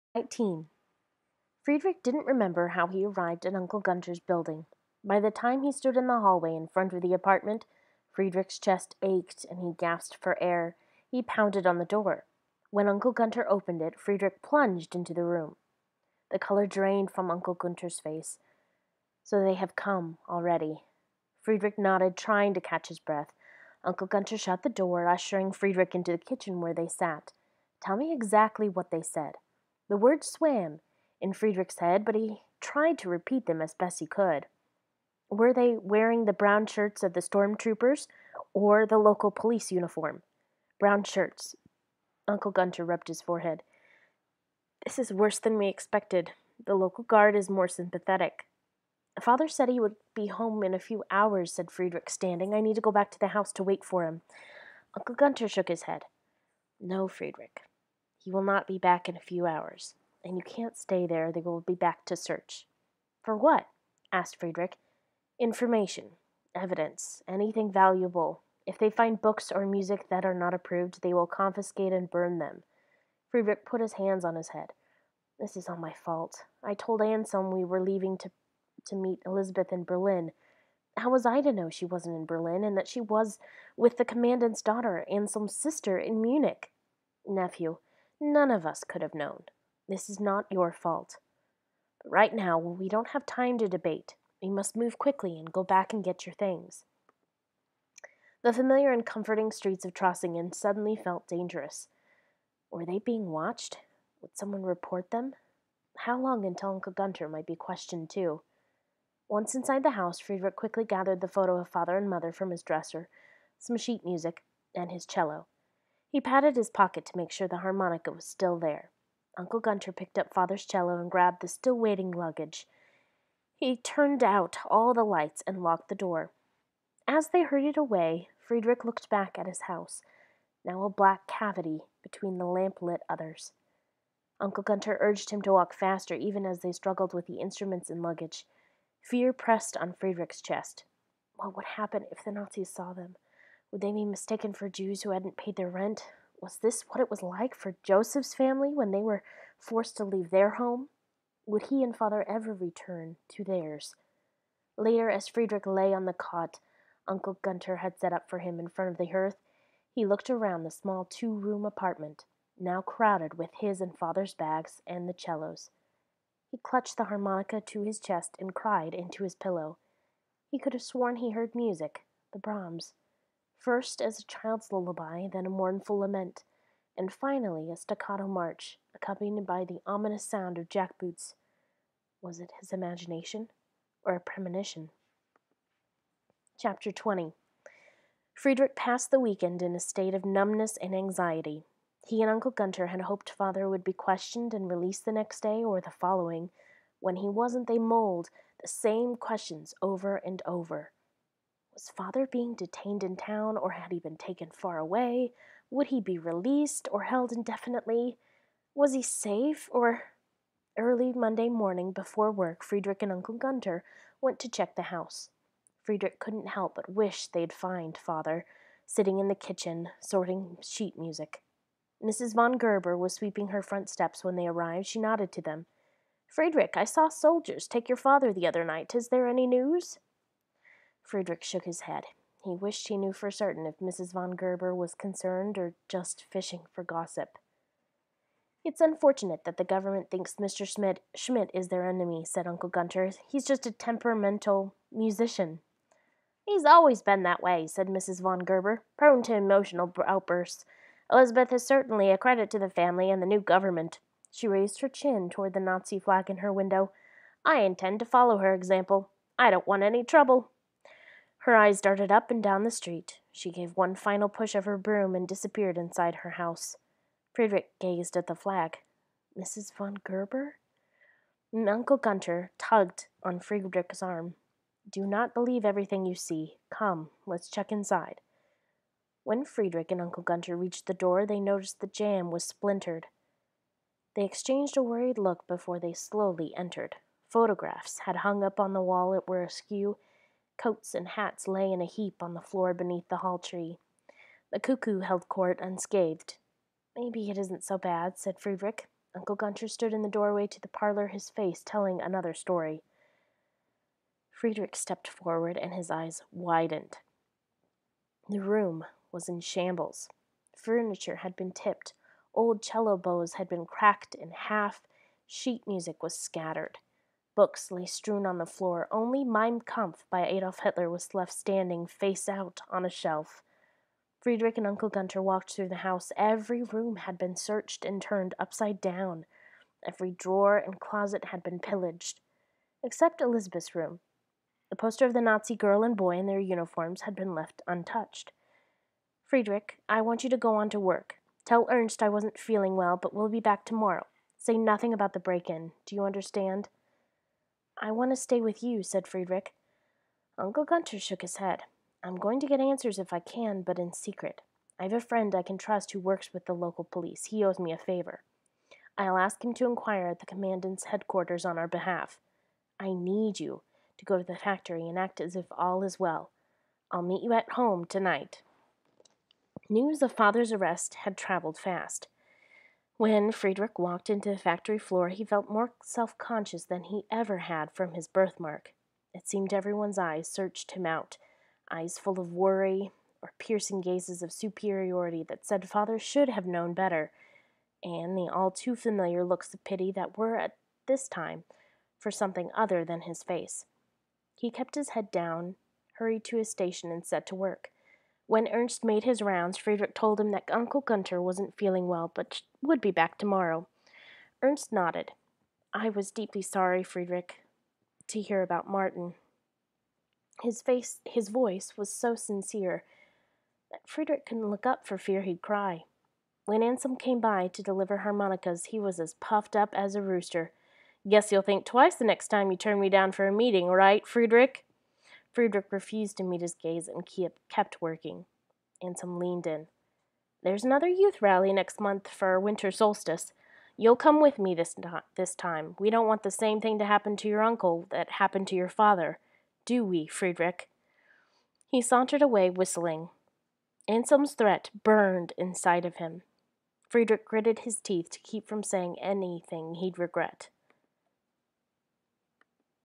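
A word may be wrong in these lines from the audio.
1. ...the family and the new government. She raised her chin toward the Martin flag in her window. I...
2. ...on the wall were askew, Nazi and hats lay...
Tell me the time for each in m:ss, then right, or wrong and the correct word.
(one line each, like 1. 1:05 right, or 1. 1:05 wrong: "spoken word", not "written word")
1. 4:12 wrong: "Nazi", not "Martin"
2. 4:48 wrong: "Coats", not "Nazi".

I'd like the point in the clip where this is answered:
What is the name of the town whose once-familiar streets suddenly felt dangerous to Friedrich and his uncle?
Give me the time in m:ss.
1:39.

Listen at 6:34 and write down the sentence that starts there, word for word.
He kept his head down, hurried to his station, and set to work.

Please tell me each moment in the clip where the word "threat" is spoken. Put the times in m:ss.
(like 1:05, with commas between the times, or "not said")
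7:24.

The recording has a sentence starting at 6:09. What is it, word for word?
News of father's arrest had traveled fast.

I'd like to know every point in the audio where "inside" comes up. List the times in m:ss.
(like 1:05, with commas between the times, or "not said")
1:49, 4:25, 4:37, 7:25.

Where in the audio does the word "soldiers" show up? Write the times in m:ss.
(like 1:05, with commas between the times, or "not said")
3:47.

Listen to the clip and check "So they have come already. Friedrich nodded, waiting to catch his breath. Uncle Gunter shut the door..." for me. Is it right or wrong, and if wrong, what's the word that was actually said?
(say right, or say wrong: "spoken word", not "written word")
wrong: "trying", not "waiting".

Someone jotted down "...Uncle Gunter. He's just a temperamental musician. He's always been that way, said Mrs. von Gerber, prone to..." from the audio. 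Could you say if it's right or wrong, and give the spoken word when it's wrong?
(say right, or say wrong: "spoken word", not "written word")
right.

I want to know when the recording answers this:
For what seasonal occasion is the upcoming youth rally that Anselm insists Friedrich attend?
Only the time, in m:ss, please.
7:12.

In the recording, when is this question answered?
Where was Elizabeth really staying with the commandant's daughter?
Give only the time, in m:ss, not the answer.
1:26.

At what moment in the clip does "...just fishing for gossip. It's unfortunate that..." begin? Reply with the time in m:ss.
3:55.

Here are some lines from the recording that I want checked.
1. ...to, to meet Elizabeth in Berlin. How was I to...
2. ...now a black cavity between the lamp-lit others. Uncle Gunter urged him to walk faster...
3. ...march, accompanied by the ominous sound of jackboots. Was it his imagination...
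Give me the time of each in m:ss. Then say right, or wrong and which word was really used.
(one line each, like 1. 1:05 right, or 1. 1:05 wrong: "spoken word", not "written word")
1. 1:18 right
2. 2:10 right
3. 2:58 right.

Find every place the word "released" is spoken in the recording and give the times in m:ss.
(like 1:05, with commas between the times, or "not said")
3:14, 3:26.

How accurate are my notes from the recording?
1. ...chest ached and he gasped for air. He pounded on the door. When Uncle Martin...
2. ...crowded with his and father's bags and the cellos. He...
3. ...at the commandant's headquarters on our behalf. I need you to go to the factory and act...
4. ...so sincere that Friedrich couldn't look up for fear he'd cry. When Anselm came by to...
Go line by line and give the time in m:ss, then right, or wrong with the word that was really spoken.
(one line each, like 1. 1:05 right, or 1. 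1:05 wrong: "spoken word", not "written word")
1. 0:08 wrong: "Gunter", not "Martin"
2. 2:42 right
3. 6:00 right
4. 6:51 right.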